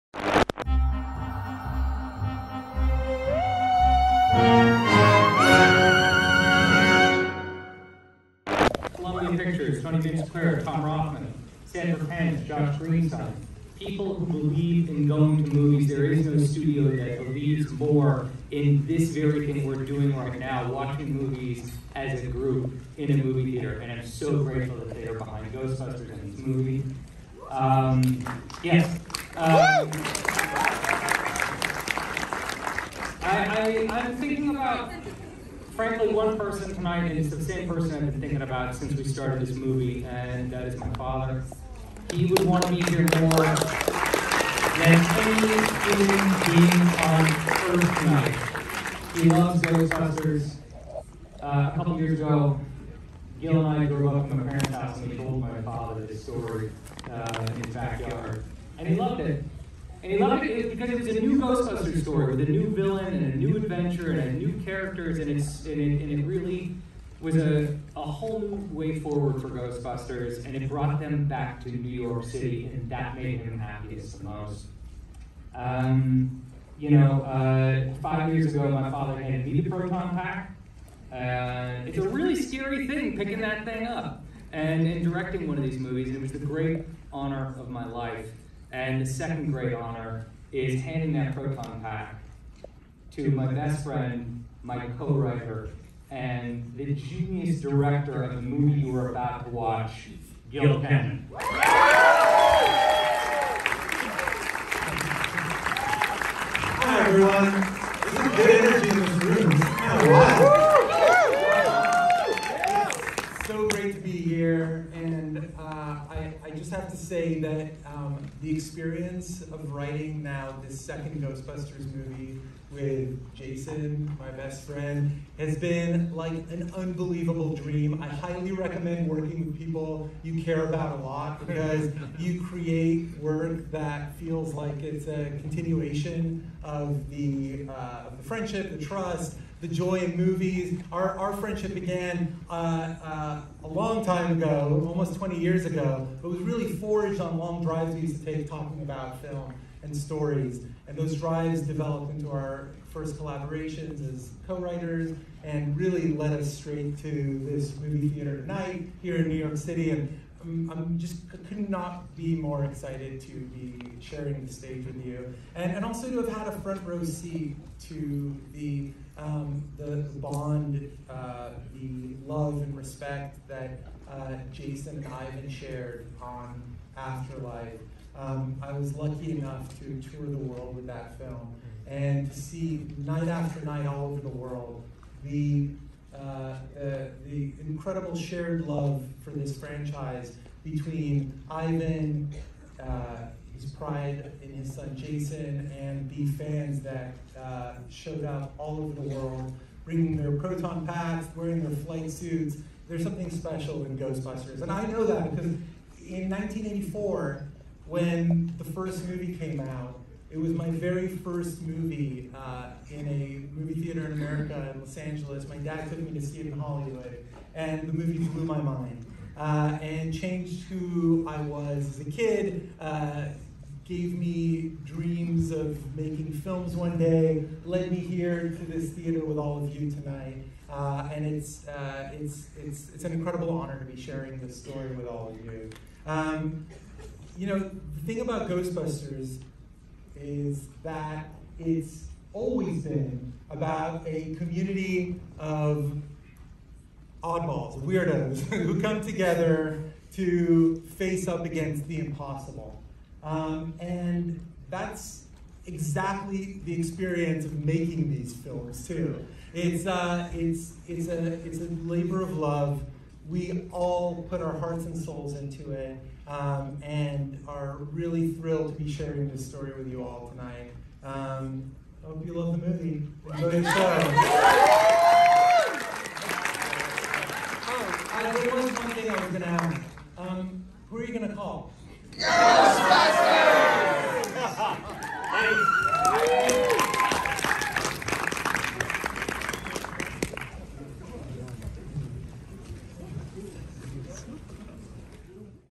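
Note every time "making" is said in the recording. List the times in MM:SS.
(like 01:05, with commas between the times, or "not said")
03:45, 04:17.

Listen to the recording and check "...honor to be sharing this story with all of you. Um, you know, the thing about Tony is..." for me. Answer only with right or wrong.
wrong.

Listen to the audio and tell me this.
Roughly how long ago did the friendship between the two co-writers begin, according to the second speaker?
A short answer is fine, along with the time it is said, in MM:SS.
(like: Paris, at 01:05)
almost 20 years, at 02:24.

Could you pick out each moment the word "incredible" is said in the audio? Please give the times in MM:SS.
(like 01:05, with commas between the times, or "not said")
03:07, 03:53.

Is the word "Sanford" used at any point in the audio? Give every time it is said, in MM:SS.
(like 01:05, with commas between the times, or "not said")
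00:11.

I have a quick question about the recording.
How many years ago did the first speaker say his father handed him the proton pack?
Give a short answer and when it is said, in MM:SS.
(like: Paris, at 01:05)
5, at 01:18.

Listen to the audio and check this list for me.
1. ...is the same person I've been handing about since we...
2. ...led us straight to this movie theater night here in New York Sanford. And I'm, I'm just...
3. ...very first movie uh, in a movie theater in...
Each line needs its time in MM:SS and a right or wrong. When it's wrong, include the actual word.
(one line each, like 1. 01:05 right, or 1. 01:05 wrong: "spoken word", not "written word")
1. 00:37 wrong: "thinking", not "handing"
2. 02:36 wrong: "City", not "Sanford"
3. 03:30 right.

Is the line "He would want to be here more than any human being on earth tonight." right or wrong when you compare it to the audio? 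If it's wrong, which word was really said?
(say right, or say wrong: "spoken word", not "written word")
right.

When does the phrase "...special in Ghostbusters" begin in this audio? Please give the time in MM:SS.
03:23.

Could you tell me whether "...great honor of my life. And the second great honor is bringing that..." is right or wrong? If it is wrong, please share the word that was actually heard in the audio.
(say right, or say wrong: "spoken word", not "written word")
wrong: "handing", not "bringing".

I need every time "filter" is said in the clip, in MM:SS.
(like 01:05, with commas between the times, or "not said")
not said.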